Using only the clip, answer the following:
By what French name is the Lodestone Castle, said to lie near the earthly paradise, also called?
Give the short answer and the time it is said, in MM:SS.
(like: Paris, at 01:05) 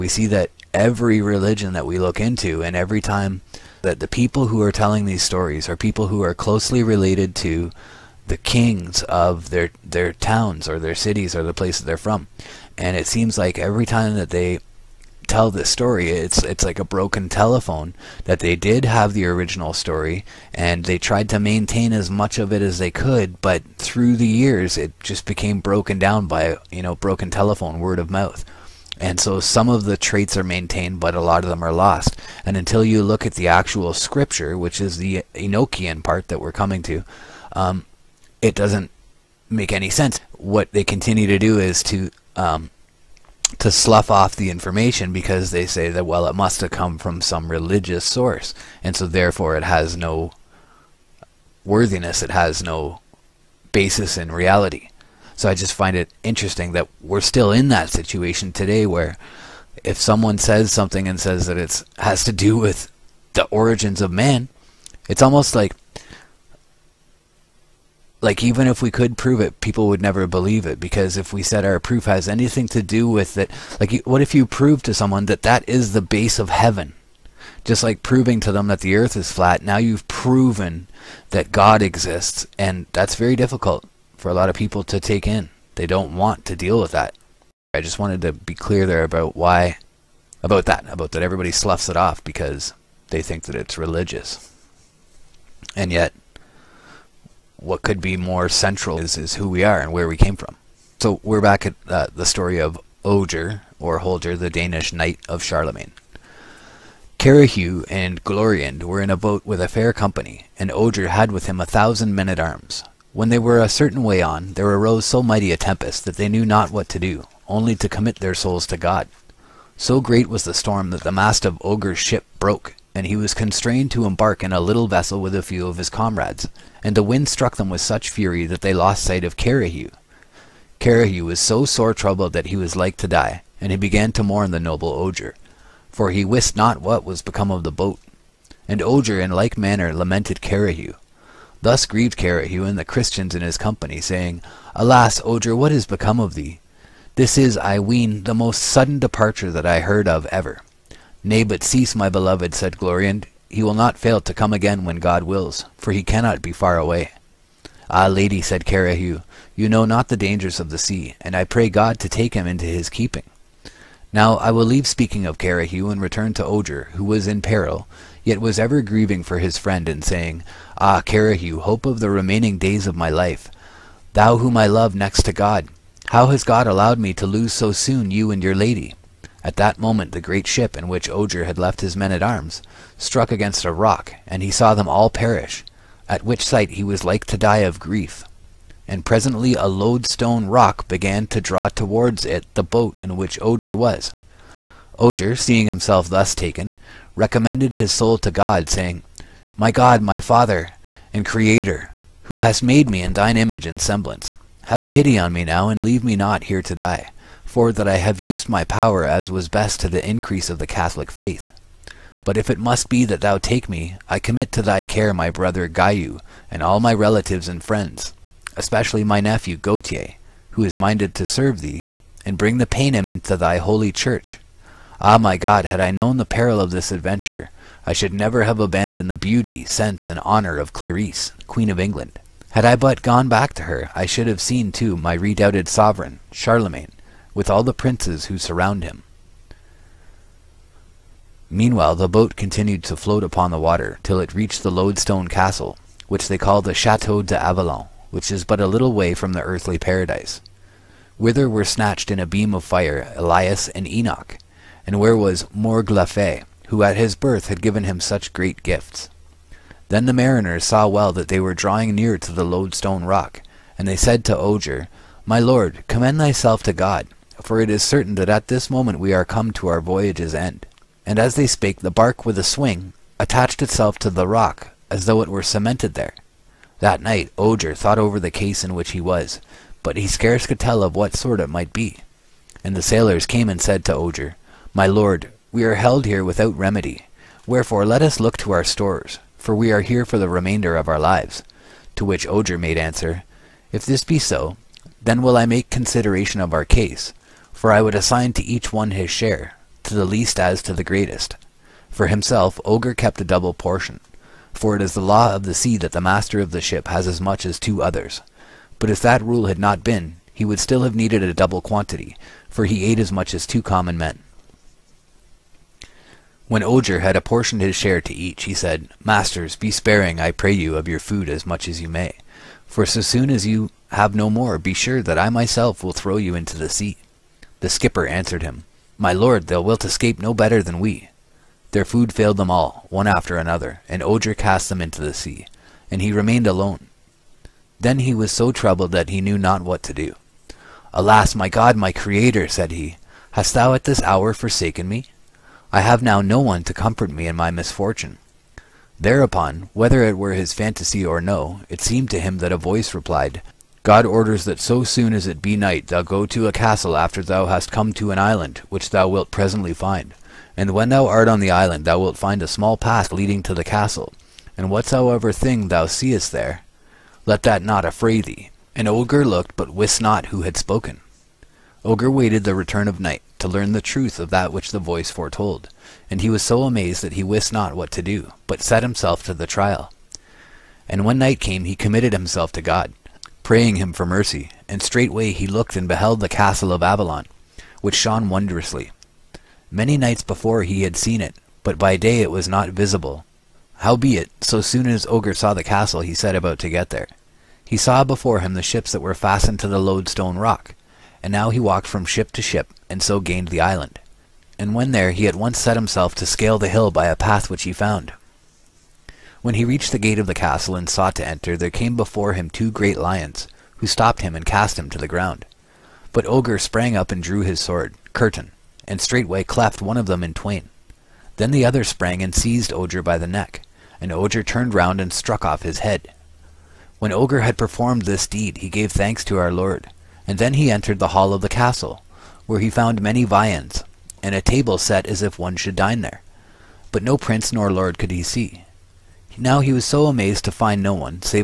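Chateau d'Avalon, at 04:06.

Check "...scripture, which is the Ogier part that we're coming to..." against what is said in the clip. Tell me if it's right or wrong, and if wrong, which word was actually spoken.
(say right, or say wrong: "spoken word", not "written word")
wrong: "Enochian", not "Ogier".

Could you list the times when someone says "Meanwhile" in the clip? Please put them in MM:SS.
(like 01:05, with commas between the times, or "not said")
04:01.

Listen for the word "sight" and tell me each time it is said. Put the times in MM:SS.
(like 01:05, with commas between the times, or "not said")
02:09, 03:06.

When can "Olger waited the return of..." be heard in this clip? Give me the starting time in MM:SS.
06:11.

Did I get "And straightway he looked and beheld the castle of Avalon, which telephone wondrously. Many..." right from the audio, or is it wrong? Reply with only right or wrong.
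wrong.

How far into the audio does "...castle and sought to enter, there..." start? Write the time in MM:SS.
06:50.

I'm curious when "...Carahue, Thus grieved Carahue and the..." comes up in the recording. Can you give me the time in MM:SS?
02:20.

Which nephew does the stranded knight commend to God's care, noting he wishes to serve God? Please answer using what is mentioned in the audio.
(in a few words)
Gautier.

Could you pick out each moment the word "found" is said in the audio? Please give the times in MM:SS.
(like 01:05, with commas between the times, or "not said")
06:47, 07:12.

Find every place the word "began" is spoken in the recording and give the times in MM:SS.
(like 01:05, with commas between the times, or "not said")
02:13, 03:10.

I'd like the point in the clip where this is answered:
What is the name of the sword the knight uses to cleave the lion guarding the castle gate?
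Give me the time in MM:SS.
06:58.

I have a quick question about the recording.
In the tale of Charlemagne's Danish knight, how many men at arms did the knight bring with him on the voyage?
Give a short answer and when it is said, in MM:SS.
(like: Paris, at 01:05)
1000, at 01:51.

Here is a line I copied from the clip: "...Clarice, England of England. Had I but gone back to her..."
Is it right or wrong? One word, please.
wrong.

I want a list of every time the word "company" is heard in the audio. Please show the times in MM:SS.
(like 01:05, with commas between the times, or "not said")
01:49, 02:23.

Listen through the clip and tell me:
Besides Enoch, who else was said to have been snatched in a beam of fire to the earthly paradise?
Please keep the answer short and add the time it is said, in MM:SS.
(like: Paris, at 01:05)
Elias, at 04:13.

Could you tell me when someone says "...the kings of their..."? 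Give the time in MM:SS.
00:08.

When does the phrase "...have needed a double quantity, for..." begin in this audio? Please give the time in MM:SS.
05:10.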